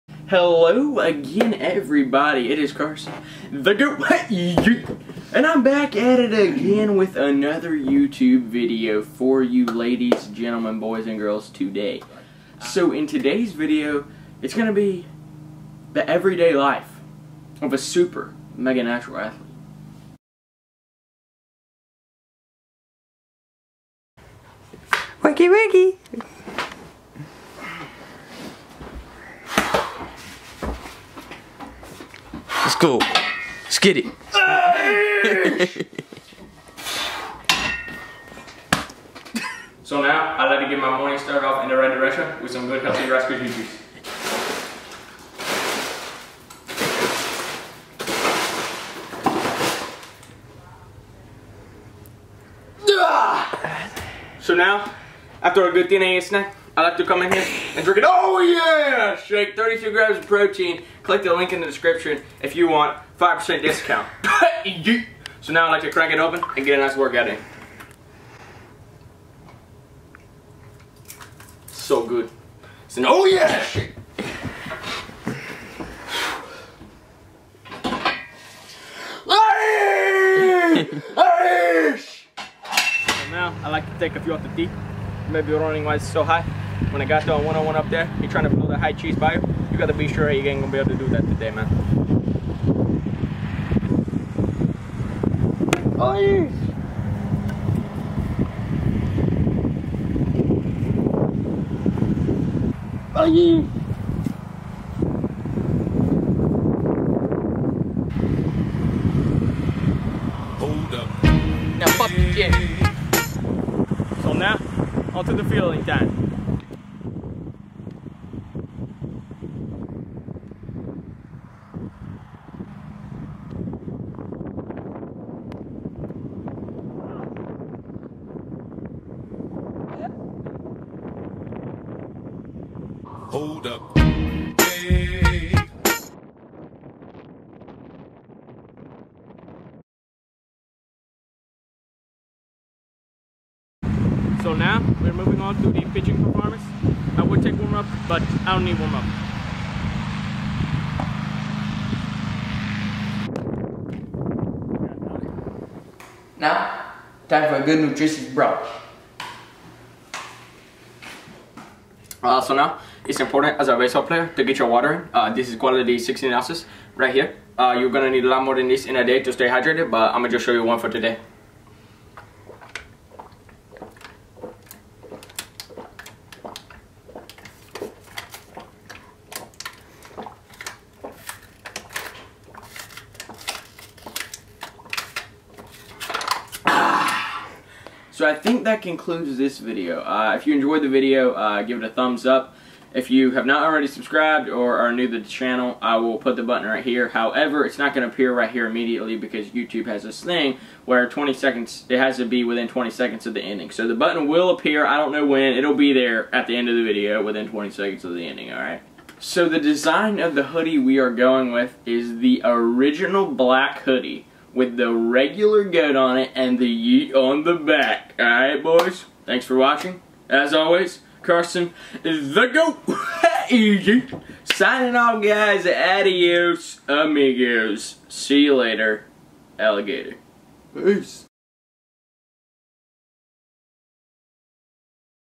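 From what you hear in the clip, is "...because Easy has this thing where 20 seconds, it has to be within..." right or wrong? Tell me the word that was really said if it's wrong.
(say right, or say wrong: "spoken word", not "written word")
wrong: "YouTube", not "Easy".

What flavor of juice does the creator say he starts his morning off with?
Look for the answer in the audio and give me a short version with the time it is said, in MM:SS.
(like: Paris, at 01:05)
raspberry, at 00:43.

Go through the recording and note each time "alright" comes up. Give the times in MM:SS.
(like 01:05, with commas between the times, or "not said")
03:28, 03:38.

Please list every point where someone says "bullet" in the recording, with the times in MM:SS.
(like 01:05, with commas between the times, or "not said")
not said.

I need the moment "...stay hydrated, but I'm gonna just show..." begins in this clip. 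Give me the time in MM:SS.
02:49.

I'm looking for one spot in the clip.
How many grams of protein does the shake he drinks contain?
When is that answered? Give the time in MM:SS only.
00:59.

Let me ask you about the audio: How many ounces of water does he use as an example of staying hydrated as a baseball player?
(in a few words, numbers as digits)
16.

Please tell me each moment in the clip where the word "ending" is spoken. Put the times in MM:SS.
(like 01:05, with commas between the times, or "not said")
03:23, 03:28.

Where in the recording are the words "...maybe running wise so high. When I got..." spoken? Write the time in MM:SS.
01:25.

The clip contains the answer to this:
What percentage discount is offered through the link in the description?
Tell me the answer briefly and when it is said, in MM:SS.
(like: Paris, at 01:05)
5%, at 01:03.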